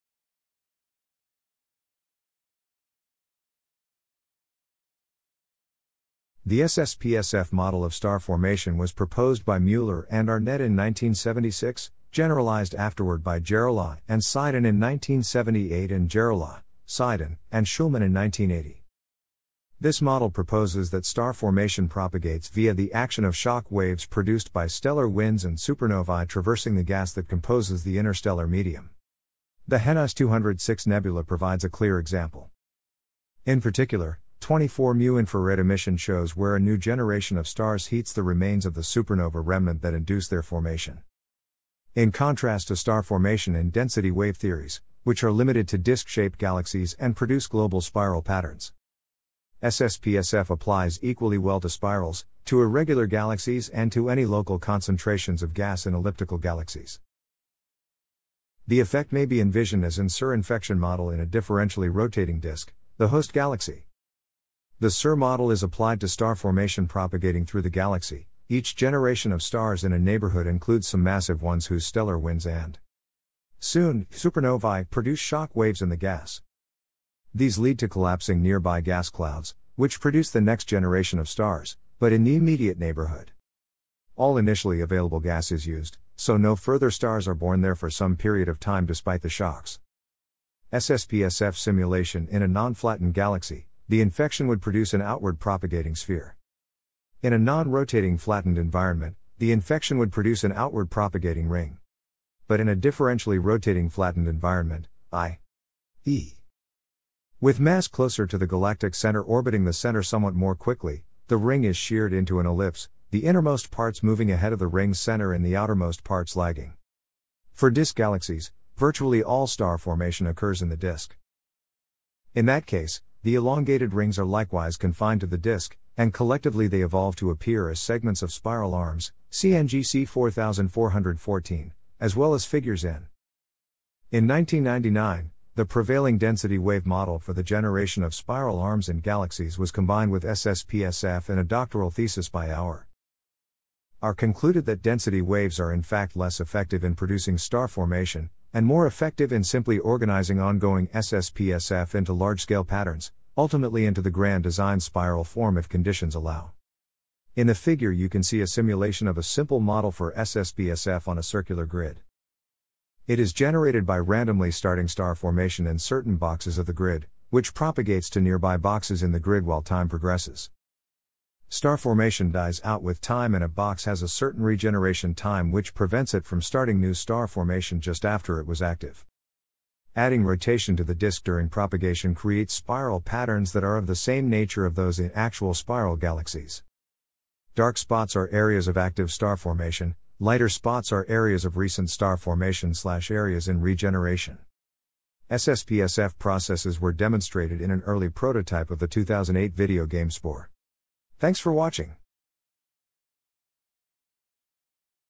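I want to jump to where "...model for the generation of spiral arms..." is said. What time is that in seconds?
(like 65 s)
136 s.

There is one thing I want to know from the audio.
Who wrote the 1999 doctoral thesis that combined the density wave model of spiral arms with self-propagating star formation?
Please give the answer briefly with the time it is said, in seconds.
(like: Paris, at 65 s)
Auer, at 142 s.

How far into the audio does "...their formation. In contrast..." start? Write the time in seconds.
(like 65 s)
40 s.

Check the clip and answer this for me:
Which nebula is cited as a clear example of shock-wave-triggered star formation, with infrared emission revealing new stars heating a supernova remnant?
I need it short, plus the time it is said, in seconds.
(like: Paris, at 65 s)
Henize 206, at 29 s.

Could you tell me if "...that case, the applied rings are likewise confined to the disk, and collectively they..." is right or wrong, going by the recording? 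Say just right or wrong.
wrong.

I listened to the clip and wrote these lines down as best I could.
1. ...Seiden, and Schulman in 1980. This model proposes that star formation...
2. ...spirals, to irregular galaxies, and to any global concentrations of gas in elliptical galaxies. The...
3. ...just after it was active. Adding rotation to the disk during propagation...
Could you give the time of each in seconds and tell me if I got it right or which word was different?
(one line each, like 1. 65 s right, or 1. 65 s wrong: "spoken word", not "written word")
1. 16 s right
2. 51 s wrong: "local", not "global"
3. 177 s right.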